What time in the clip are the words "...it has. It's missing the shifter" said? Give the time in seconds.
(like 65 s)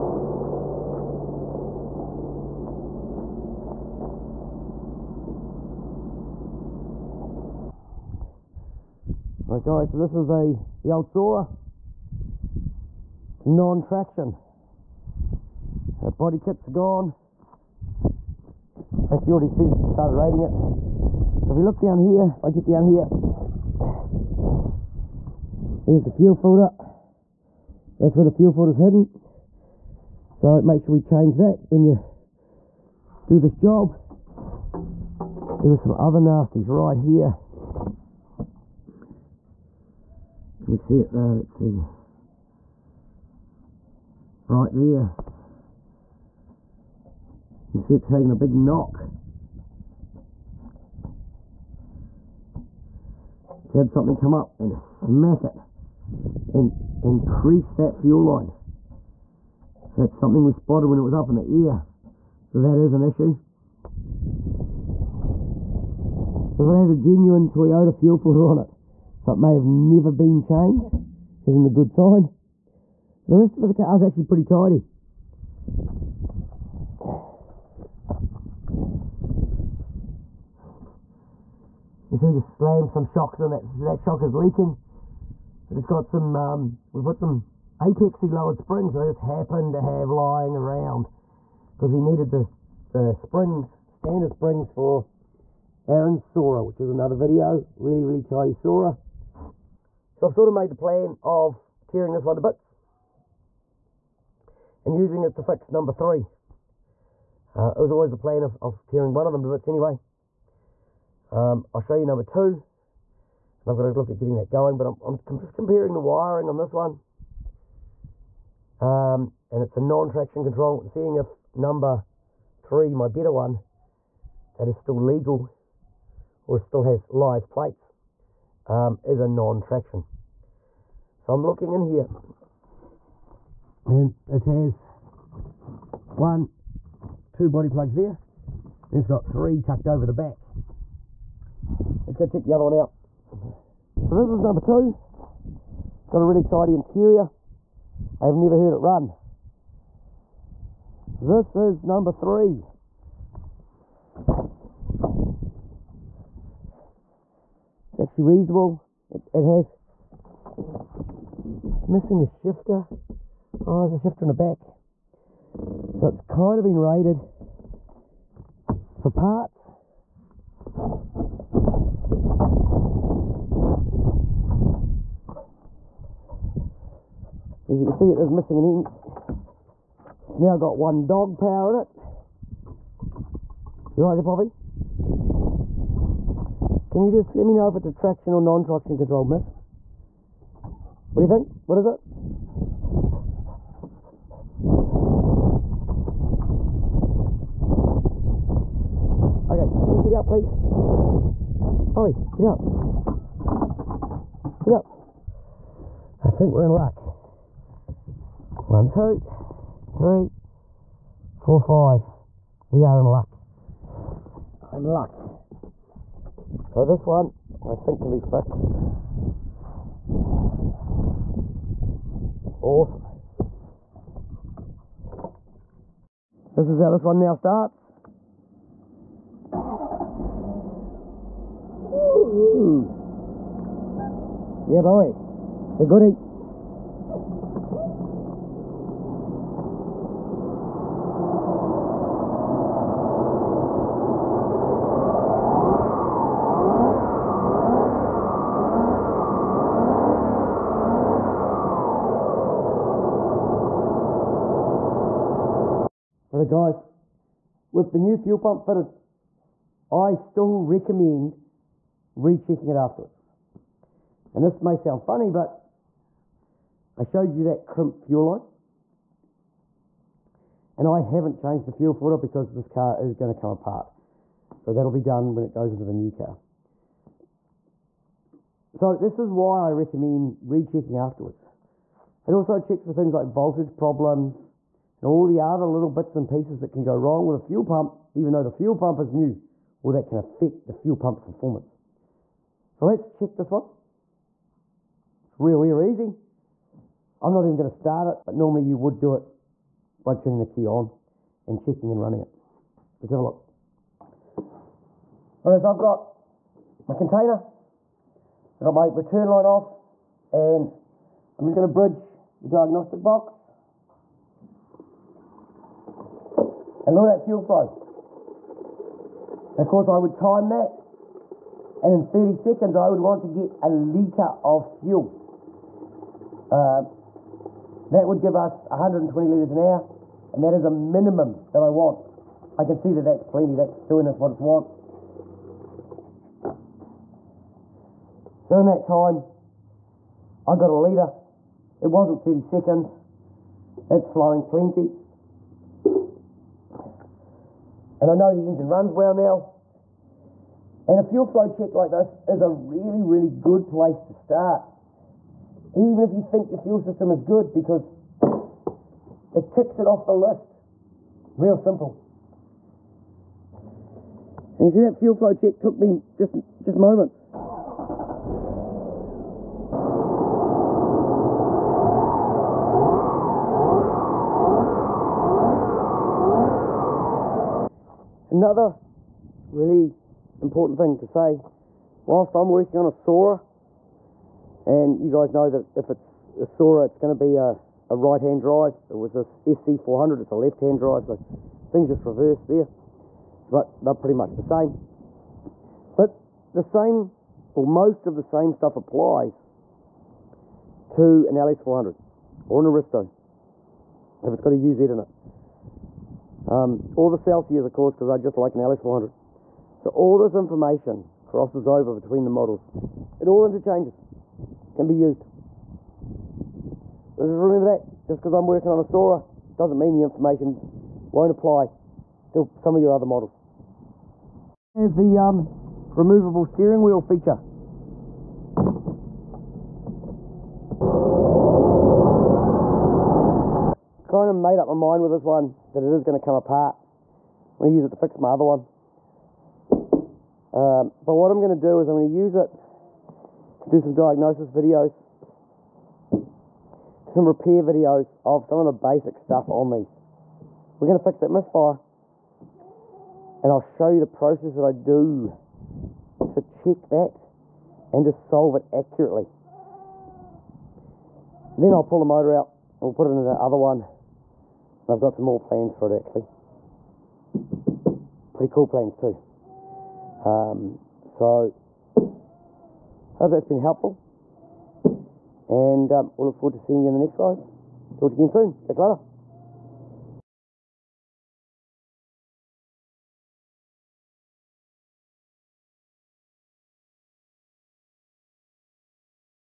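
159 s.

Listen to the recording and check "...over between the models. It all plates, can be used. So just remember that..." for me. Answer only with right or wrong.
wrong.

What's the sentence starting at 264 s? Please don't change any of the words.
And this may sound funny, but I showed you that crimp fuel line.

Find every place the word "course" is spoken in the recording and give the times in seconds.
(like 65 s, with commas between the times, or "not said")
319 s, 407 s.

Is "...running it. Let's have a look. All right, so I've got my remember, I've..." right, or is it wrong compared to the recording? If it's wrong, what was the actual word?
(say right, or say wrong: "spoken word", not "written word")
wrong: "container", not "remember".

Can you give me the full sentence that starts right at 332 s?
I can see that that's plenty, that's doing us what it's want.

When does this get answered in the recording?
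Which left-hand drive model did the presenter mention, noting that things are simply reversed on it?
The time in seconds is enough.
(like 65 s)
389 s.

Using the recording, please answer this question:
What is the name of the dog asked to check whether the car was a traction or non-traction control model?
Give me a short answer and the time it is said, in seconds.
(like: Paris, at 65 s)
Poppy, at 184 s.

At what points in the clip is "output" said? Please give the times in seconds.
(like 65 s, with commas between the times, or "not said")
not said.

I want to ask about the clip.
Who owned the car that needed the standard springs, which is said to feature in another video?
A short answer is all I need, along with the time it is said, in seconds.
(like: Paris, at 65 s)
Aaron, at 95 s.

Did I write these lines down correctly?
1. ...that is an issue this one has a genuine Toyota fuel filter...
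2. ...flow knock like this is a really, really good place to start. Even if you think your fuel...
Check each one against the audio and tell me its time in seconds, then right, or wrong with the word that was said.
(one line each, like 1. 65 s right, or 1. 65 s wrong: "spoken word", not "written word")
1. 62 s right
2. 351 s wrong: "check", not "knock".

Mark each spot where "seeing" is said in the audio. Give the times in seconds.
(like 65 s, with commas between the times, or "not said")
120 s, 476 s.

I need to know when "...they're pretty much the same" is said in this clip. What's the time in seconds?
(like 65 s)
393 s.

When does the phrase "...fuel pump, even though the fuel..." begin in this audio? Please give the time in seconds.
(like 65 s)
287 s.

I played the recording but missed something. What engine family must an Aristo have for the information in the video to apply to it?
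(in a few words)
UZ.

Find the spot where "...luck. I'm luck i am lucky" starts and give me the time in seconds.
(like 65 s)
213 s.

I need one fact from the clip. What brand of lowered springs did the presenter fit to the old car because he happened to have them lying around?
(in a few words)
Apexi.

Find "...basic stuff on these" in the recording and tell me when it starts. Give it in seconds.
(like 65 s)
448 s.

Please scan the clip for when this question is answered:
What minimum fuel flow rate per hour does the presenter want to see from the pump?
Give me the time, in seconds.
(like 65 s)
328 s.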